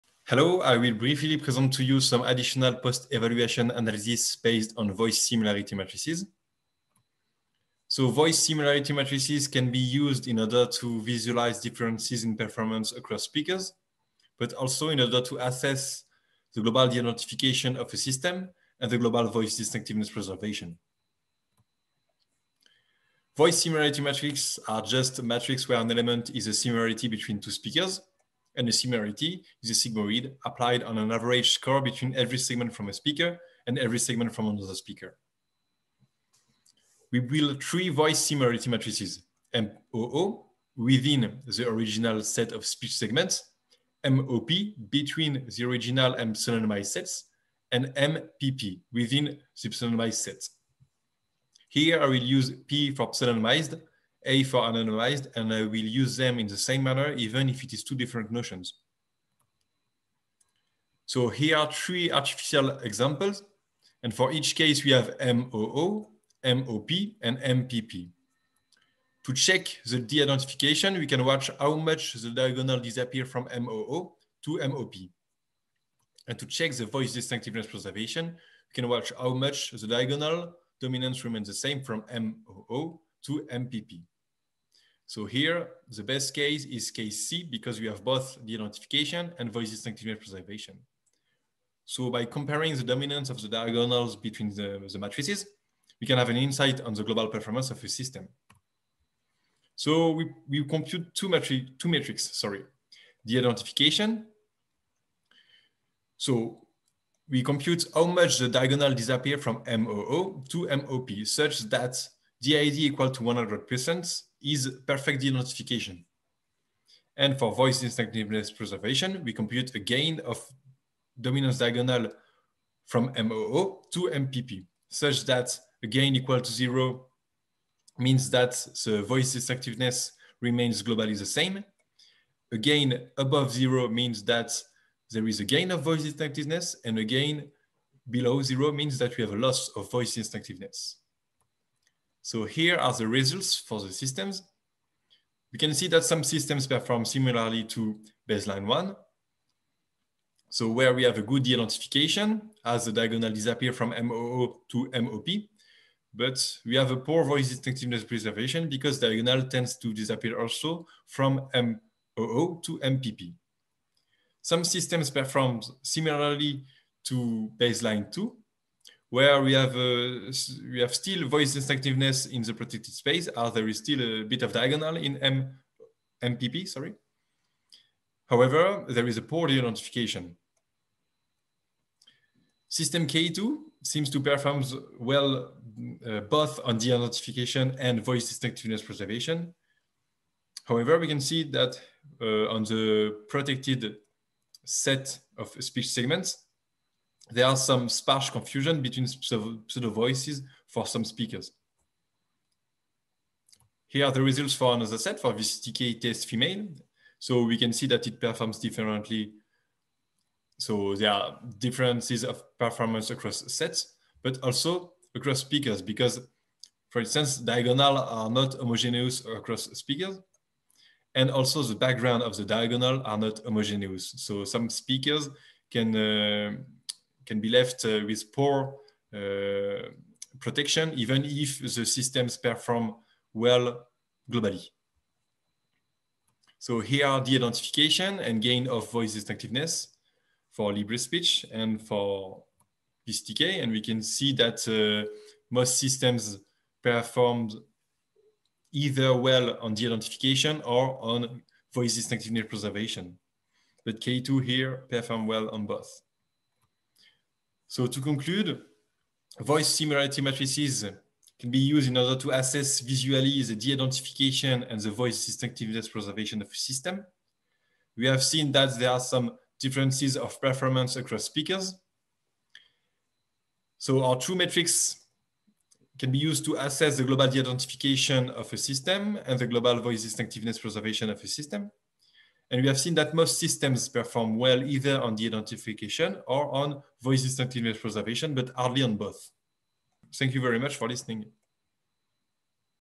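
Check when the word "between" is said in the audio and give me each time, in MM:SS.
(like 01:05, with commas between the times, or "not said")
00:27, 00:31, 00:44, 01:34, 03:18.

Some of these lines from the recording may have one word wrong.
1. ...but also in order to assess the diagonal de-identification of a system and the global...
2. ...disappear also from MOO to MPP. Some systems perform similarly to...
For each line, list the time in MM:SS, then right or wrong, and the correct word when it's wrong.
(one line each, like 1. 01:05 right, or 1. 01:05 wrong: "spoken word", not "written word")
1. 00:14 wrong: "global", not "diagonal"
2. 02:39 right.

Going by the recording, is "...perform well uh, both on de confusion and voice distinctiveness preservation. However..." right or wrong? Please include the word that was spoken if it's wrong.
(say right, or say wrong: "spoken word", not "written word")
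wrong: "identification", not "confusion".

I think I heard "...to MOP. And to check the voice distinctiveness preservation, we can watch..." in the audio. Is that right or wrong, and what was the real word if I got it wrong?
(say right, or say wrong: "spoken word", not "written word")
right.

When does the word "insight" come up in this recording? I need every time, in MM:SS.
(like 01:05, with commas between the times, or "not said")
01:36.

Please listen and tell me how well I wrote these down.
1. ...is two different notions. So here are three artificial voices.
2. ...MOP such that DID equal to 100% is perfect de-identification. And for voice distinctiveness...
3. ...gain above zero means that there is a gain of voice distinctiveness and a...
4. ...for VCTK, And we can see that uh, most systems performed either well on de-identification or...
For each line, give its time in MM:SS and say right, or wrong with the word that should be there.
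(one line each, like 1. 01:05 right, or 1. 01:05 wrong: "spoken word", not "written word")
1. 00:57 wrong: "examples", not "voices"
2. 01:50 right
3. 02:12 right
4. 04:01 right.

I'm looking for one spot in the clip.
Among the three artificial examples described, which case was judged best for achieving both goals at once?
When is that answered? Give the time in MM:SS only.
01:26.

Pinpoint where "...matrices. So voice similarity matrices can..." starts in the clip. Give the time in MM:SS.
00:05.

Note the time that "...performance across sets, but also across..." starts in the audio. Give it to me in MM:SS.
03:32.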